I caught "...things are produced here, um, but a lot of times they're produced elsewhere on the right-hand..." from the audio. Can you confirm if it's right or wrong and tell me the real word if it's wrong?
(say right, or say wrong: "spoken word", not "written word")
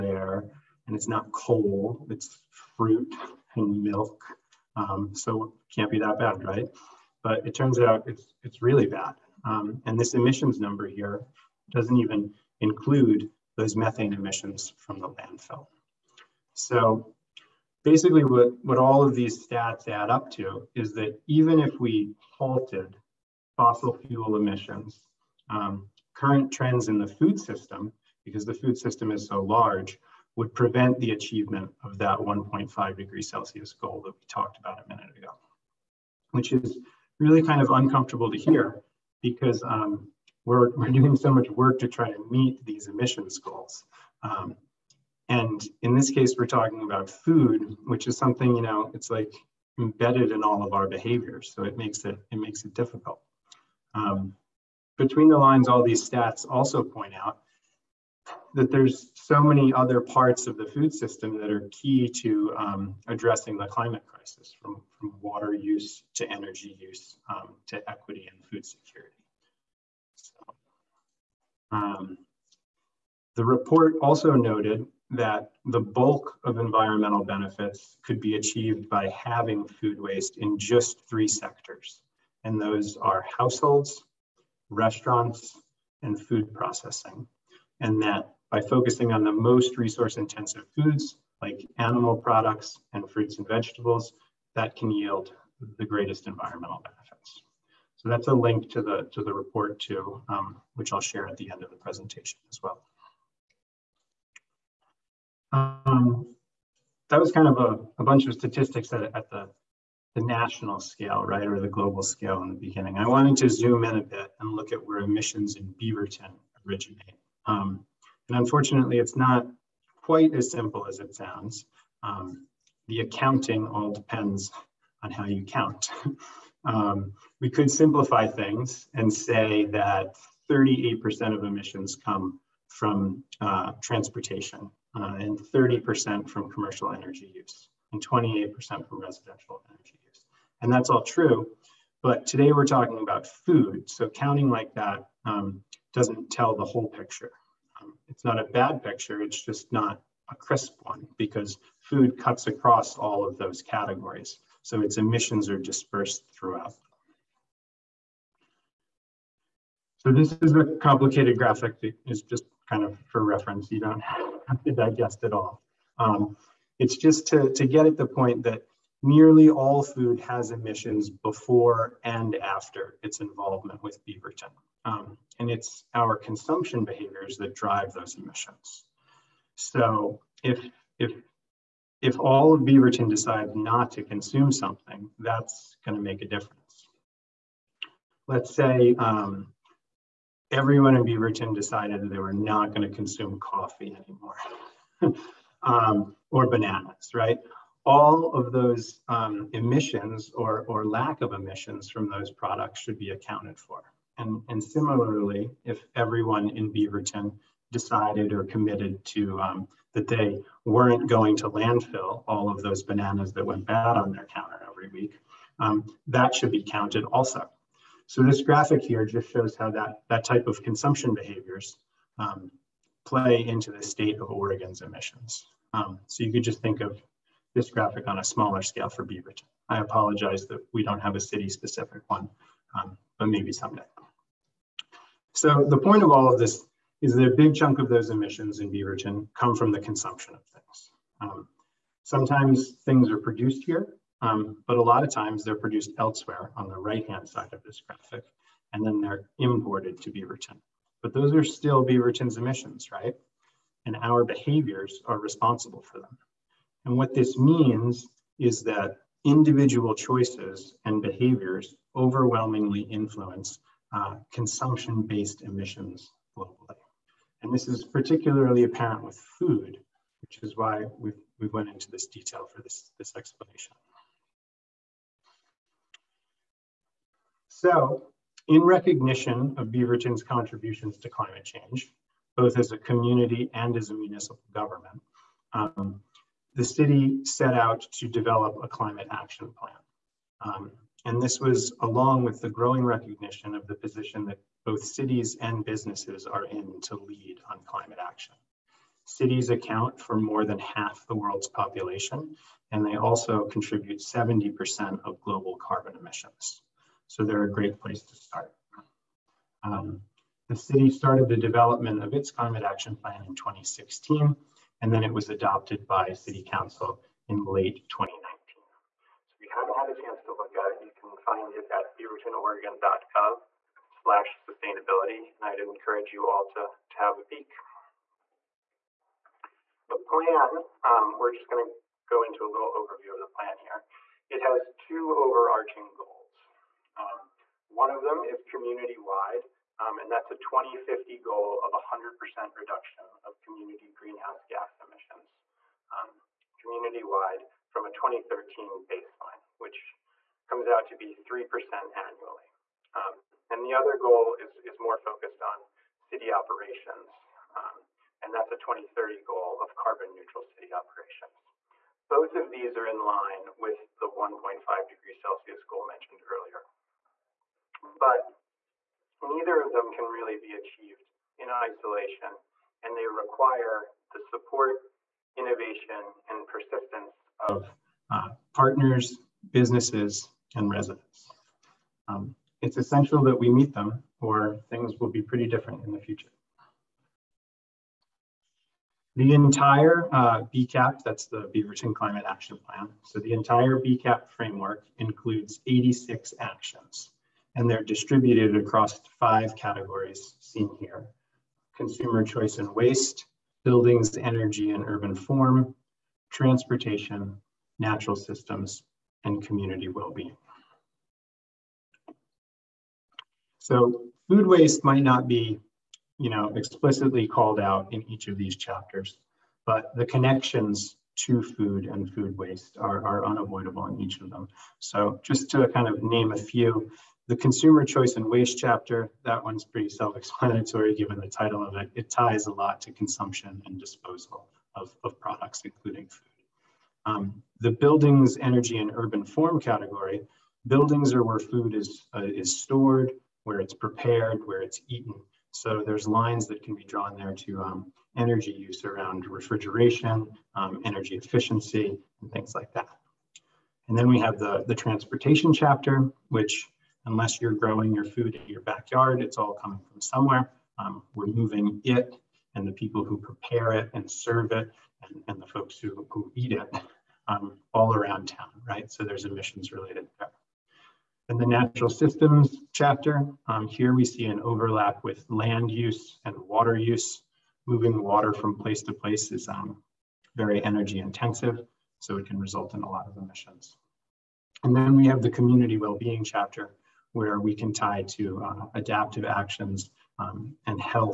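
right.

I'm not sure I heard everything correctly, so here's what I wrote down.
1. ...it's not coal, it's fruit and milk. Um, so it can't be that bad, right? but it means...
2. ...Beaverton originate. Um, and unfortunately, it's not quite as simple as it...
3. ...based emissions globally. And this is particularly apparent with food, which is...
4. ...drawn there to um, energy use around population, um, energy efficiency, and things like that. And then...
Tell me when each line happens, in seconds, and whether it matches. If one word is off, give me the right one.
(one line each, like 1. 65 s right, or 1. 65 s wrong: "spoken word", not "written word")
1. 0 s wrong: "turns", not "means"
2. 115 s right
3. 265 s right
4. 446 s wrong: "refrigeration", not "population".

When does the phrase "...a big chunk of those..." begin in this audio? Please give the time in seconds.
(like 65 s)
237 s.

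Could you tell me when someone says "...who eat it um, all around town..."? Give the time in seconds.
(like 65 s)
466 s.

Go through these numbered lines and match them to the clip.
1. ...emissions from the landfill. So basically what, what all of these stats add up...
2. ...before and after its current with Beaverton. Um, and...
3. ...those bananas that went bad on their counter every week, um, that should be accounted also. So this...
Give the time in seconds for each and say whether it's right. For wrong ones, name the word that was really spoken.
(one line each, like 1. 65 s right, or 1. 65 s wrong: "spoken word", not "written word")
1. 14 s right
2. 171 s wrong: "involvement", not "current"
3. 212 s wrong: "counted", not "accounted".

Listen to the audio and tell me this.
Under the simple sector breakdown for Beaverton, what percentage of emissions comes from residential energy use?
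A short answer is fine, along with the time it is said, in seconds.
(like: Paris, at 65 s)
28%, at 138 s.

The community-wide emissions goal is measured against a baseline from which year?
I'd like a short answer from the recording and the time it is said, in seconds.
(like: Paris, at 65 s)
2013, at 347 s.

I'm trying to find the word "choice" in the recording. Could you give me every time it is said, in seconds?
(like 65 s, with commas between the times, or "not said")
259 s, 402 s, 427 s.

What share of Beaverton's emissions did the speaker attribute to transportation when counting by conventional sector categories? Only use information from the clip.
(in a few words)
38%.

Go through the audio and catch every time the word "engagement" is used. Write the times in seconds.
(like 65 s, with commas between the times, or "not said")
not said.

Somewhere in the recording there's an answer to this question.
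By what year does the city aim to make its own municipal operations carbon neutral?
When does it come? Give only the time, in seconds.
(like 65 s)
358 s.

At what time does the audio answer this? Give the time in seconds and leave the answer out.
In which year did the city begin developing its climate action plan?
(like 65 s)
313 s.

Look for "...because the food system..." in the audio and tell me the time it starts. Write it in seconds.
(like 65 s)
28 s.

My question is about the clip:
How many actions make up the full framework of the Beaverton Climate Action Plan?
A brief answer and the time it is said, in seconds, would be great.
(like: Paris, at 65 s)
86, at 395 s.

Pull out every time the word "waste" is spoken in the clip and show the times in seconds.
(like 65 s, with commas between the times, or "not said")
80 s, 402 s, 414 s, 422 s, 428 s.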